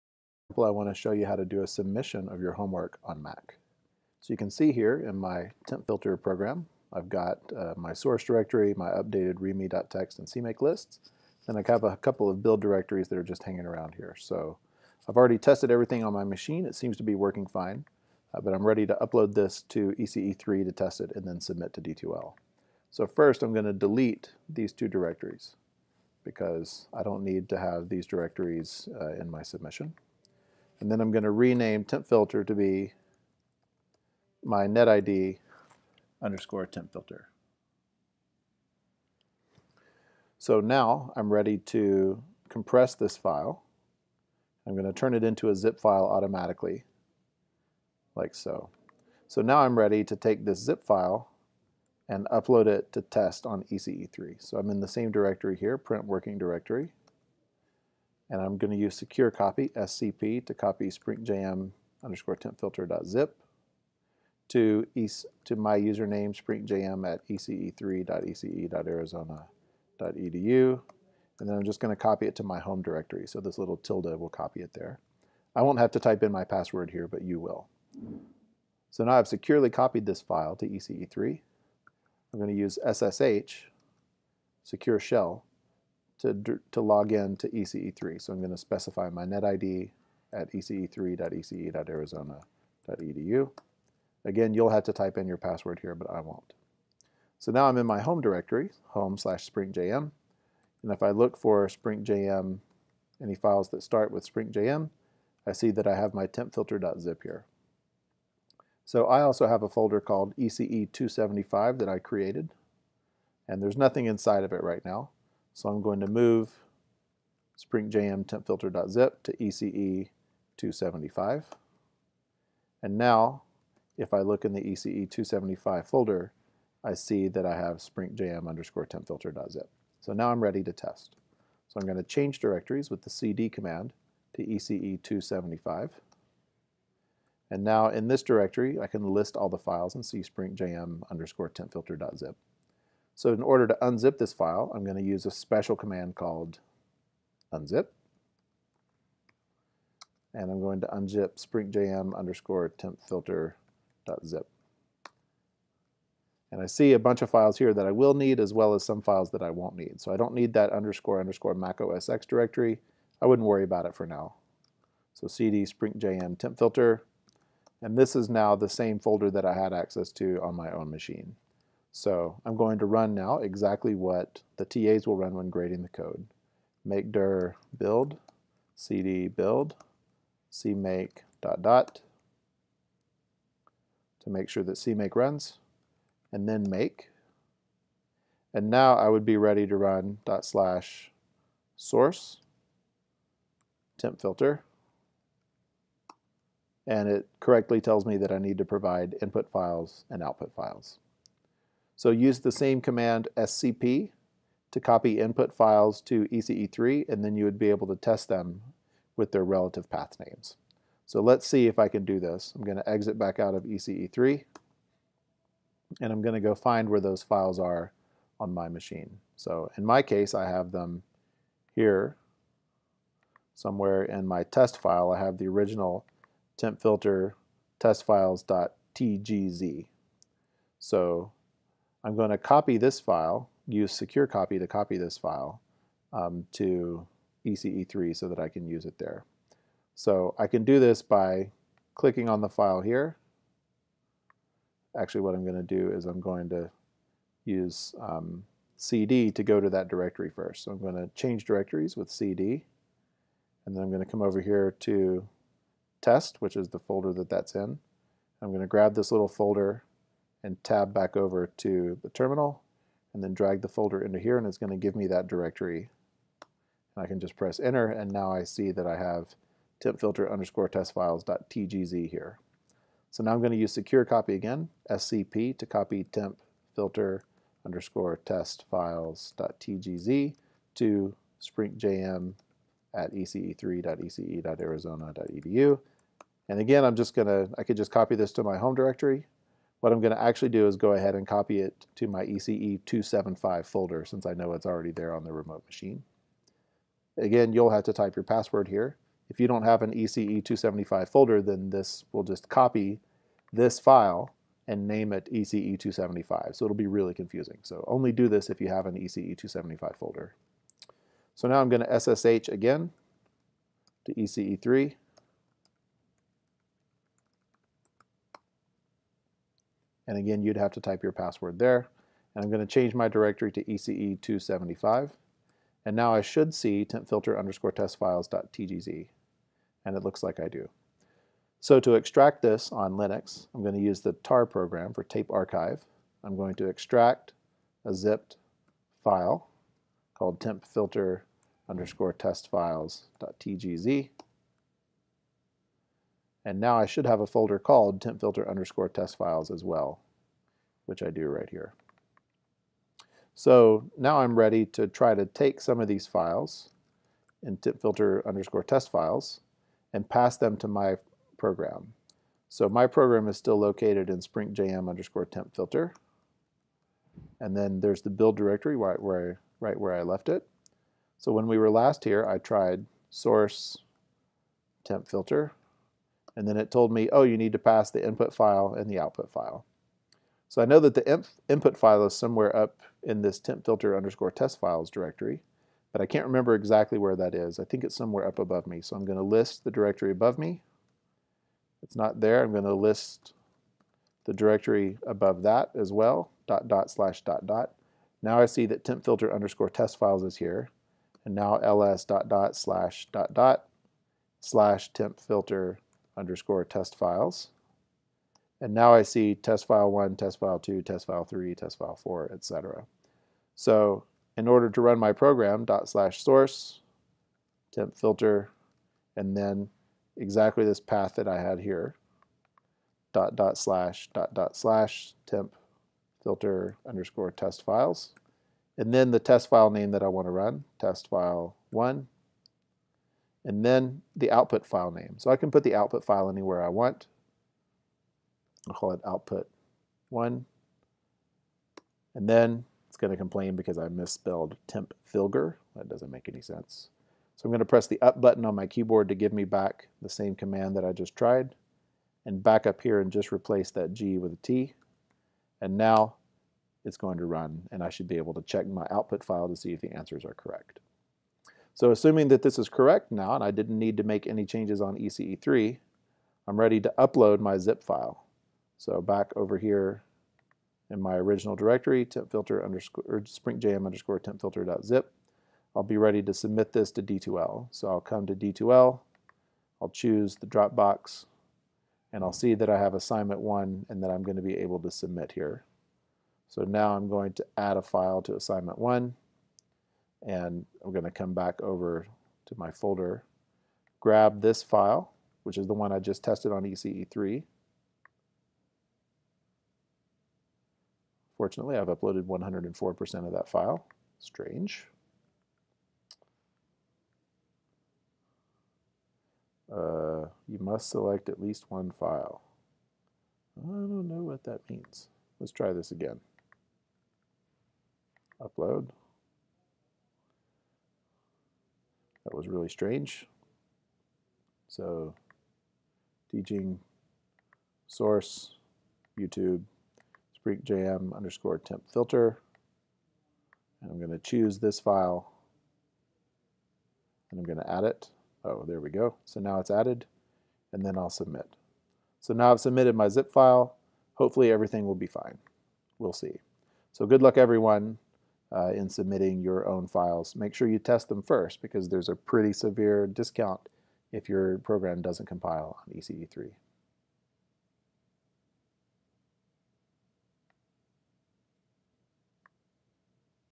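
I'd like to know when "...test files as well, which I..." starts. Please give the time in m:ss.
5:48.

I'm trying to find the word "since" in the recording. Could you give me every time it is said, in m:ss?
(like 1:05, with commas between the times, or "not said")
4:54.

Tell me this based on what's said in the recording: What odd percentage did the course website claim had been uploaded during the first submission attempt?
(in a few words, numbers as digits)
104%.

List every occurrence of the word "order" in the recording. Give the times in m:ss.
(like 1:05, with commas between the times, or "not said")
2:23, 6:54.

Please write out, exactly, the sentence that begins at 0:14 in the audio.
So I've already tested everything on my machine.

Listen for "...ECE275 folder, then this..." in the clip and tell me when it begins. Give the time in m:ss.
4:59.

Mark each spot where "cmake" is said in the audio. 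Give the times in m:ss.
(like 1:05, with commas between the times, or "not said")
0:10, 3:00, 3:04.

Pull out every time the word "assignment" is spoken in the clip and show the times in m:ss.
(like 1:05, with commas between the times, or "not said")
8:02, 8:08.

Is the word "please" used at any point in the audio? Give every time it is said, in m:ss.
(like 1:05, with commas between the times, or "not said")
not said.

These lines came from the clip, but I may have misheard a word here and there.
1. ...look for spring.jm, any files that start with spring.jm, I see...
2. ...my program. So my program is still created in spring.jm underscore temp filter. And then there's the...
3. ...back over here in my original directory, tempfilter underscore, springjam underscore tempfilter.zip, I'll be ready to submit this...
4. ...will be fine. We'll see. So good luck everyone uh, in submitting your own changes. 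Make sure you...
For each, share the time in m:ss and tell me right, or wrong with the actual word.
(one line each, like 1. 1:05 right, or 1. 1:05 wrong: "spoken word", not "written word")
1. 1:41 right
2. 6:00 wrong: "located", not "created"
3. 7:49 right
4. 9:04 wrong: "files", not "changes".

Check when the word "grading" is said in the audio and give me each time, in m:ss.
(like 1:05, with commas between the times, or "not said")
2:55.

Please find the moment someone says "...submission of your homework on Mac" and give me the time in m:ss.
0:01.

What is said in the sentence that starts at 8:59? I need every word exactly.
So now it's added and then I'll submit.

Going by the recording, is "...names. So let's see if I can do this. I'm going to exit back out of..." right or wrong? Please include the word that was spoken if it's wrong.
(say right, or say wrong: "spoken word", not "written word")
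right.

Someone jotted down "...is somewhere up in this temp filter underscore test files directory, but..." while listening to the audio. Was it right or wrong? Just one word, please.
right.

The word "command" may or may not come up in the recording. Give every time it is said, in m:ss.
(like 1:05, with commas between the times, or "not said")
2:13, 2:25, 3:22, 7:30.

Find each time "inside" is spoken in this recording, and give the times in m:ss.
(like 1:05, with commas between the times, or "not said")
1:54.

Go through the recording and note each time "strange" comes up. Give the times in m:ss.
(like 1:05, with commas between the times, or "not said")
8:24, 8:42.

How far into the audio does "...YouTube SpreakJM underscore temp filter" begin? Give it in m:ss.
8:49.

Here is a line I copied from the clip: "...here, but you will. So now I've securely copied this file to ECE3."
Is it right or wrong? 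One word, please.
right.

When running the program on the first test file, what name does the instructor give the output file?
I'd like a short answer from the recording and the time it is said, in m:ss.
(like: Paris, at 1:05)
output 1, at 7:19.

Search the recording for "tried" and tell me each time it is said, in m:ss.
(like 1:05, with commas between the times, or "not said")
6:12, 7:31.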